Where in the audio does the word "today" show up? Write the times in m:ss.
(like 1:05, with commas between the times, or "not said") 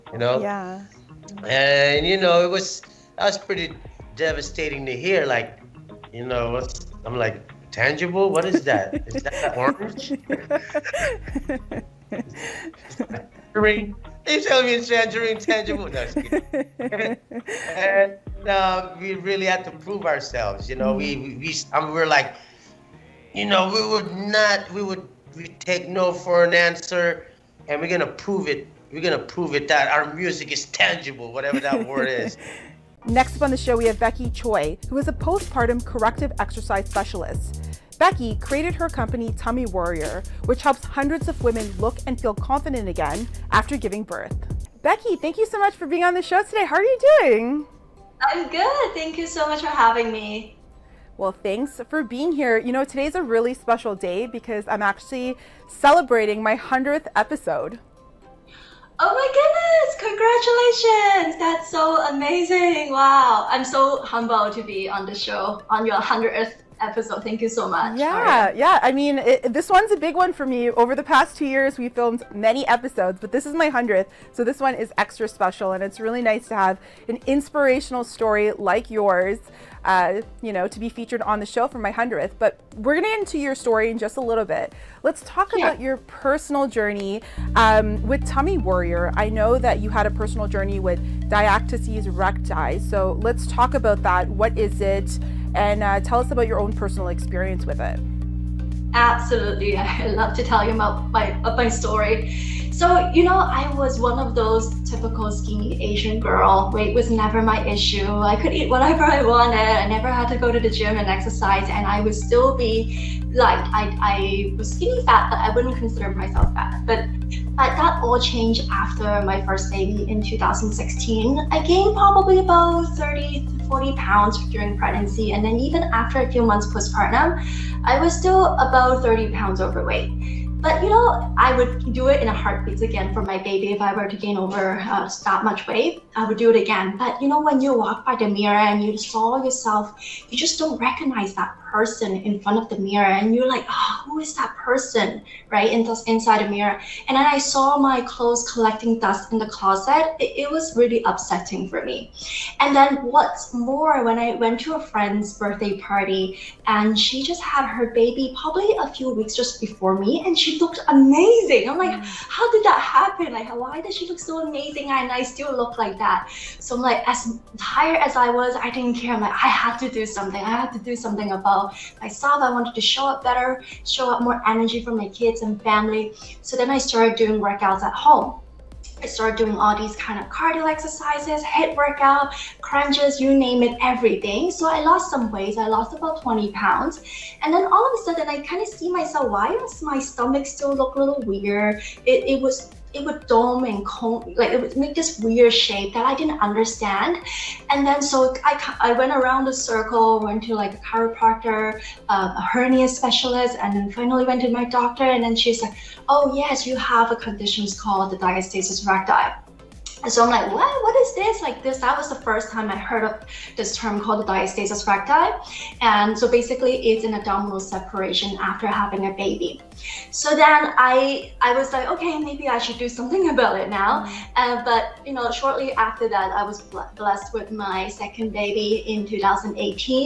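0:46, 0:52.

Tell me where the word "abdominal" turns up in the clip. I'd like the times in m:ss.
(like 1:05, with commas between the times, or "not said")
3:37.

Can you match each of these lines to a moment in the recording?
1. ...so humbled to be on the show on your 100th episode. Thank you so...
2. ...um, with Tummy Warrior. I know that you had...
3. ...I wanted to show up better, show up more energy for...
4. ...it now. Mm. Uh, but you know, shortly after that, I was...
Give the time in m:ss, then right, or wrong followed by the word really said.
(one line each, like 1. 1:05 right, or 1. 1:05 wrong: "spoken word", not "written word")
1. 1:03 right
2. 1:27 right
3. 2:52 right
4. 3:43 right.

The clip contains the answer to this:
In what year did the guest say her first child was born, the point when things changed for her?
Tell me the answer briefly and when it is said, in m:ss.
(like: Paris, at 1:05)
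2016, at 2:00.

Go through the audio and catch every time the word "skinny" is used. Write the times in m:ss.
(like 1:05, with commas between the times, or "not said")
1:45, 1:54.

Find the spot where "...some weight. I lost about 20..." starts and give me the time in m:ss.
3:05.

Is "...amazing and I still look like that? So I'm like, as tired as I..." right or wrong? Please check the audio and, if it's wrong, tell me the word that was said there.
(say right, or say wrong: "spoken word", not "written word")
right.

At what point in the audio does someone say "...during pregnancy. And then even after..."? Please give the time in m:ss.
2:04.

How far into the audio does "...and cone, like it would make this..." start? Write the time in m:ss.
3:13.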